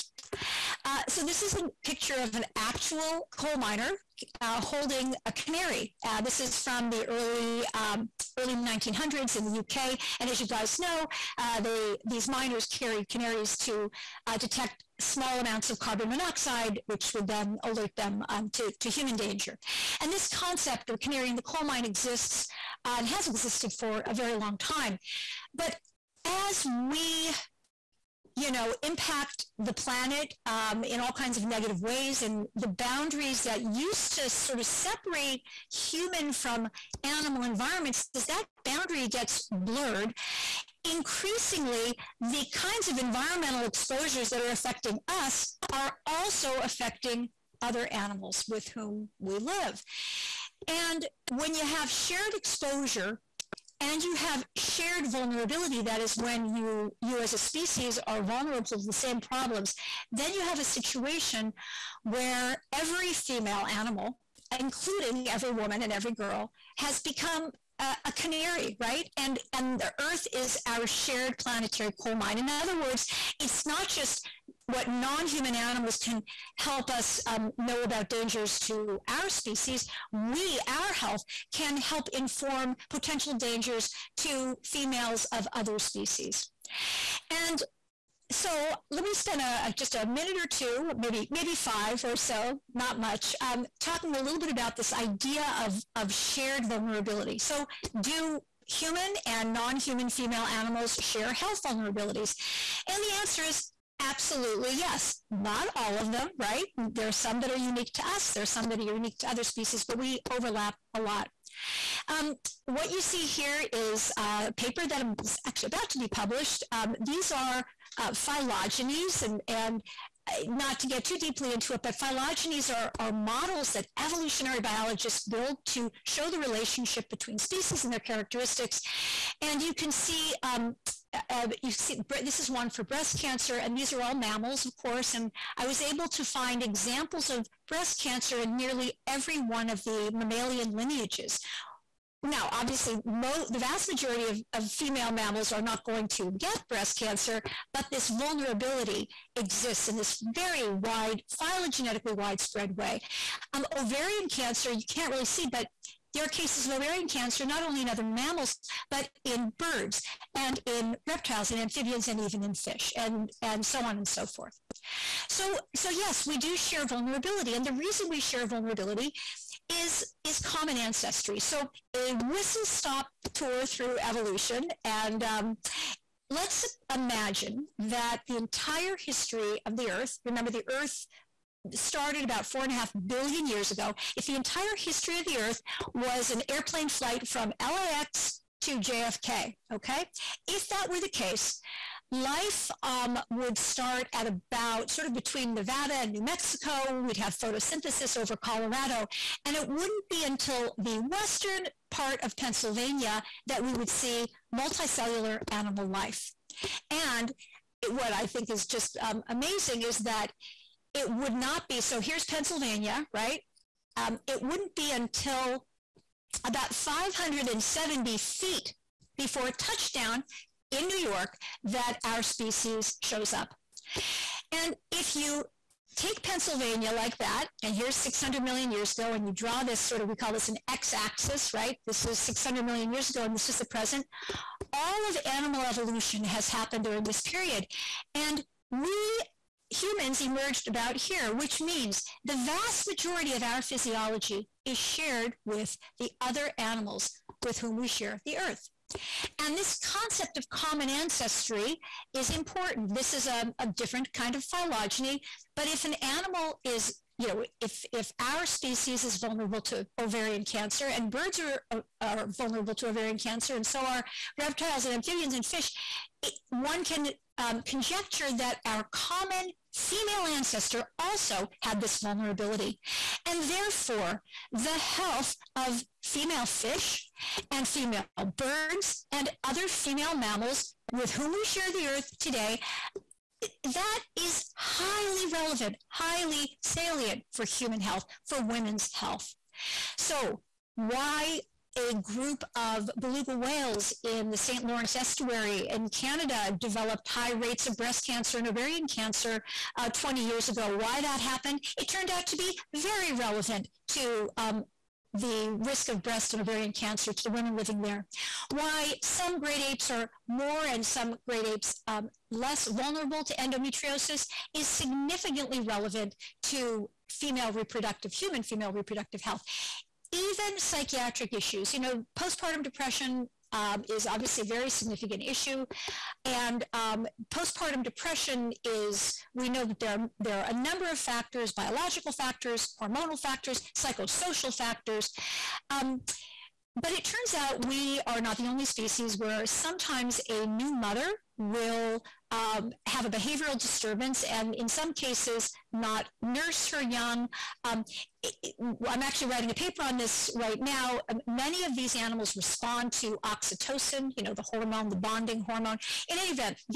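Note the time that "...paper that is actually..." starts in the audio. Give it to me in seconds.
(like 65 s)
114 s.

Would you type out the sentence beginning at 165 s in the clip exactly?
So, so yes, we do share vulnerability.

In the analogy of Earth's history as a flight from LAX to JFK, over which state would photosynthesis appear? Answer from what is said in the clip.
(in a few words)
Colorado.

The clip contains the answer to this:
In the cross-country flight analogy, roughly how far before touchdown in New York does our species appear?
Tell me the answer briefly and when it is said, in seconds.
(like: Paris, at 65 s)
570 feet, at 216 s.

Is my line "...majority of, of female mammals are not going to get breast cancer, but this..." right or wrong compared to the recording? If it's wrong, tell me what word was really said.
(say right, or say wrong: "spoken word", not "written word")
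right.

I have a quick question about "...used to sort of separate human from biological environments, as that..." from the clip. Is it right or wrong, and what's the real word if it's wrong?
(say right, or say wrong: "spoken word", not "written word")
wrong: "animal", not "biological".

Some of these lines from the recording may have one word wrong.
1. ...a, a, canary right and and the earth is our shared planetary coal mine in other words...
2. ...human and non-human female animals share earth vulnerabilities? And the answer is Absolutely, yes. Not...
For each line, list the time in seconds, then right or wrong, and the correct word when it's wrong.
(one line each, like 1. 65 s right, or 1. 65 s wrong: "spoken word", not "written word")
1. 67 s right
2. 98 s wrong: "health", not "earth".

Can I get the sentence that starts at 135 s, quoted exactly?
And I was able to find examples of breast cancer in nearly every one of the mammalian lineages.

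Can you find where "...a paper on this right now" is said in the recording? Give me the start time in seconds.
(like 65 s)
349 s.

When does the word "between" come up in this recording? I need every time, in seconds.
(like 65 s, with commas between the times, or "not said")
127 s, 195 s.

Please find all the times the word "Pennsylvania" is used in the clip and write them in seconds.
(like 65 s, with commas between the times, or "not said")
202 s, 212 s, 226 s.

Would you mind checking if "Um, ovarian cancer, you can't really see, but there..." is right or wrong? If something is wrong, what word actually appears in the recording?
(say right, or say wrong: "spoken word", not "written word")
right.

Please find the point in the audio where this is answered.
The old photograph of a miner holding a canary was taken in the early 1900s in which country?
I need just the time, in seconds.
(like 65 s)
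9 s.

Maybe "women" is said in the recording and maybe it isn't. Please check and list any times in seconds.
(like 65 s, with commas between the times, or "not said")
288 s, 307 s.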